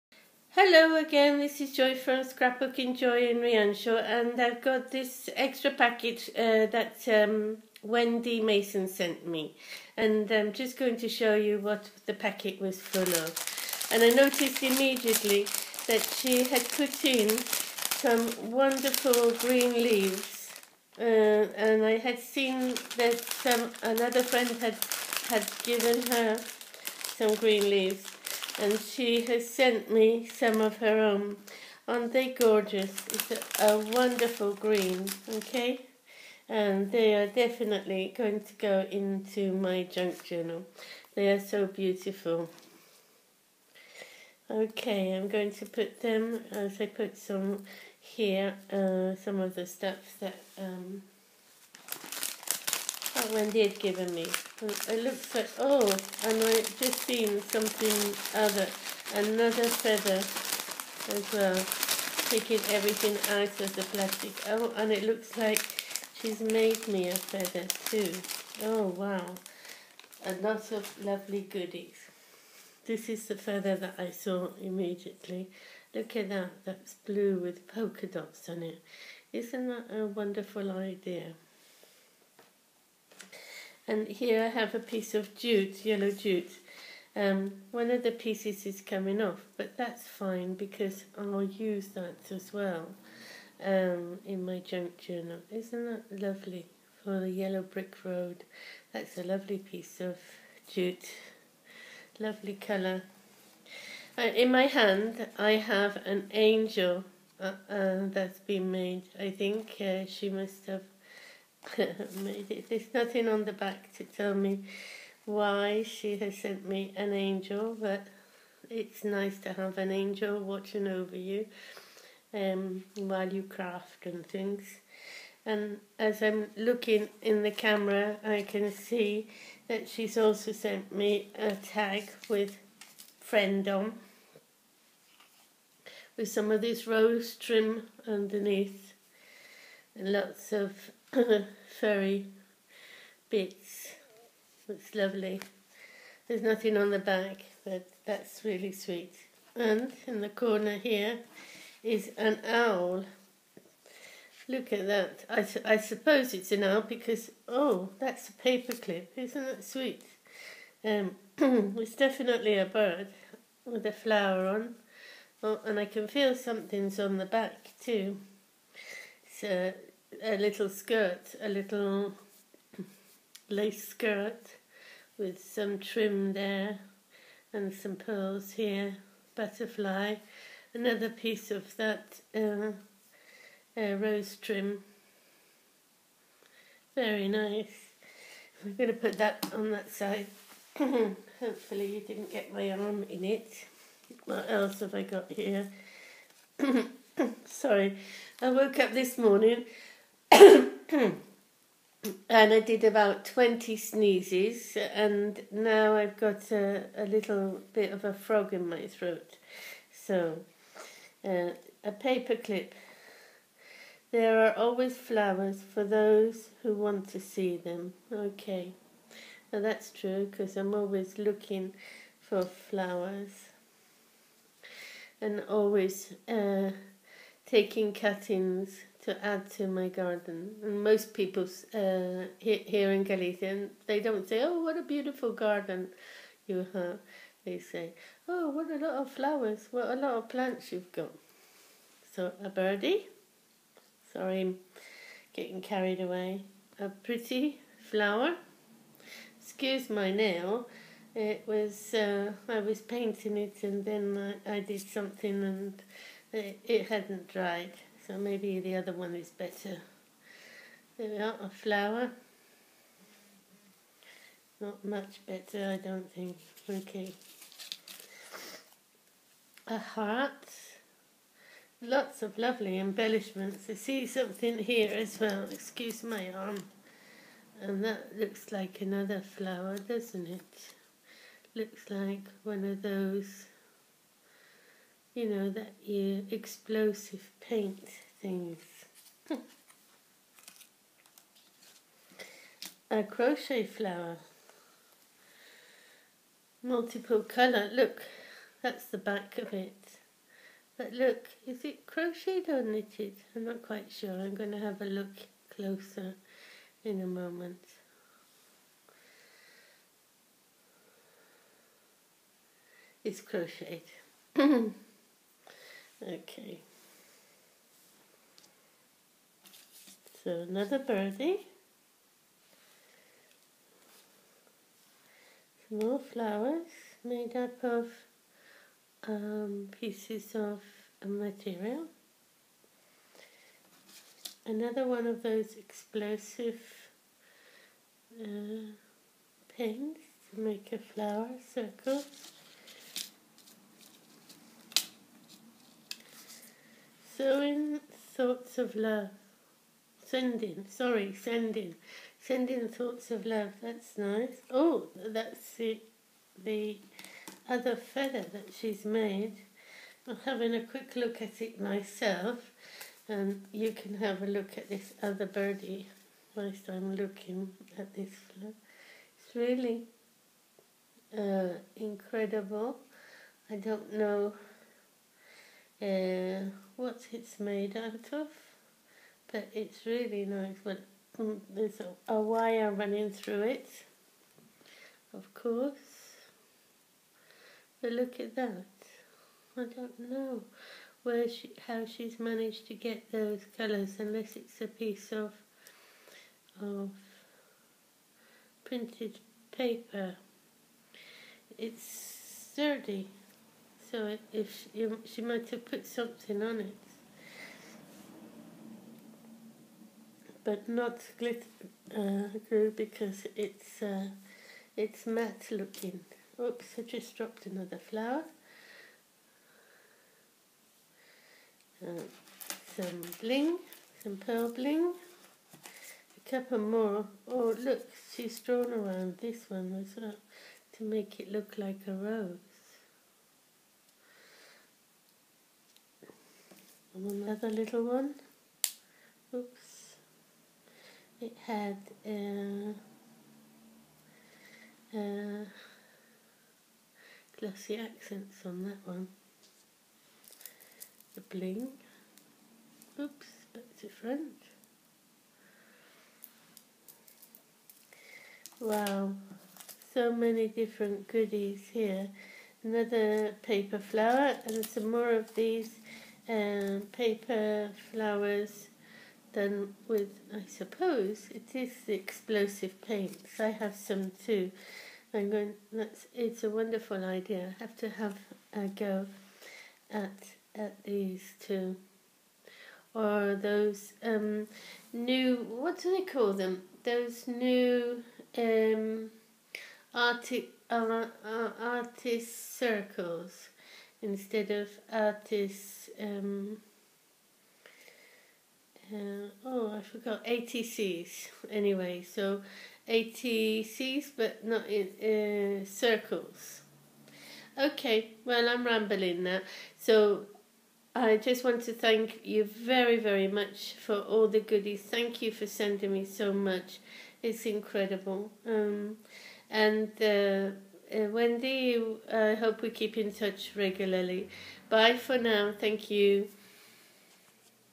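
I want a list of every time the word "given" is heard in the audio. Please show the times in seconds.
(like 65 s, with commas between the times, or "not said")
25 s, 53 s.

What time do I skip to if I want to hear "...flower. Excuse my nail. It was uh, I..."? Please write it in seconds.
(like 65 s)
247 s.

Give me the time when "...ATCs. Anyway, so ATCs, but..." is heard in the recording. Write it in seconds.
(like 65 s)
500 s.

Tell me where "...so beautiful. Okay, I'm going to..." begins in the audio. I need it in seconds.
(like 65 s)
41 s.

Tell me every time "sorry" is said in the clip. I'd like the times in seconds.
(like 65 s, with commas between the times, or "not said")
197 s, 244 s, 350 s.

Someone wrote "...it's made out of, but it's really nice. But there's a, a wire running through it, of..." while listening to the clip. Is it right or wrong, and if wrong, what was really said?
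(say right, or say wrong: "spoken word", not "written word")
right.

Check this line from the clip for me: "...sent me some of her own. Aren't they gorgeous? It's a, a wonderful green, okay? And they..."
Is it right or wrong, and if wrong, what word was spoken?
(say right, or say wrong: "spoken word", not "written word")
right.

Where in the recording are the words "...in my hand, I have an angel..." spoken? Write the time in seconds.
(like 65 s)
104 s.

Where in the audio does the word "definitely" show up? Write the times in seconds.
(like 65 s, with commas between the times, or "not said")
37 s, 161 s.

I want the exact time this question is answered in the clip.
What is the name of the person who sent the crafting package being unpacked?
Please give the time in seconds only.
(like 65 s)
7 s.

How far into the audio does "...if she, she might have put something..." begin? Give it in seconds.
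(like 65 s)
404 s.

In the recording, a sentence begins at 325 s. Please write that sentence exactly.
Some more flowers made up of um, pieces of material.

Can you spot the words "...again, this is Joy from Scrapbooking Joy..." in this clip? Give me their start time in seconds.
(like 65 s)
0 s.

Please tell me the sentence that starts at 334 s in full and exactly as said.
Another one of those explosive uh, pins to make a flower circle.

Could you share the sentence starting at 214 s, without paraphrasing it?
There are always flowers for those who want to see them.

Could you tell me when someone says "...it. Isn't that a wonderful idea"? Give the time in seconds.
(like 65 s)
78 s.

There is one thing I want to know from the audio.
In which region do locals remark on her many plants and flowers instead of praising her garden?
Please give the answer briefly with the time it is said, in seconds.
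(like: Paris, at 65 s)
Galicia, at 233 s.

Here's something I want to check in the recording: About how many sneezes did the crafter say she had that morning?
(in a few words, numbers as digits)
20.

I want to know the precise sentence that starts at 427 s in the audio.
Oh, look, she's drawn around this one as well to make it look like a rose.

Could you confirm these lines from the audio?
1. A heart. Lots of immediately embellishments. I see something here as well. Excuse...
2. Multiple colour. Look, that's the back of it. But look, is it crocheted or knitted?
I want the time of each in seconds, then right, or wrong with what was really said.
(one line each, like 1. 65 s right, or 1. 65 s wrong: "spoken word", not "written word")
1. 269 s wrong: "lovely", not "immediately"
2. 296 s right.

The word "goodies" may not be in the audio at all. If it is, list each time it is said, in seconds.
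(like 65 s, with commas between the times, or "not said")
71 s, 461 s, 514 s.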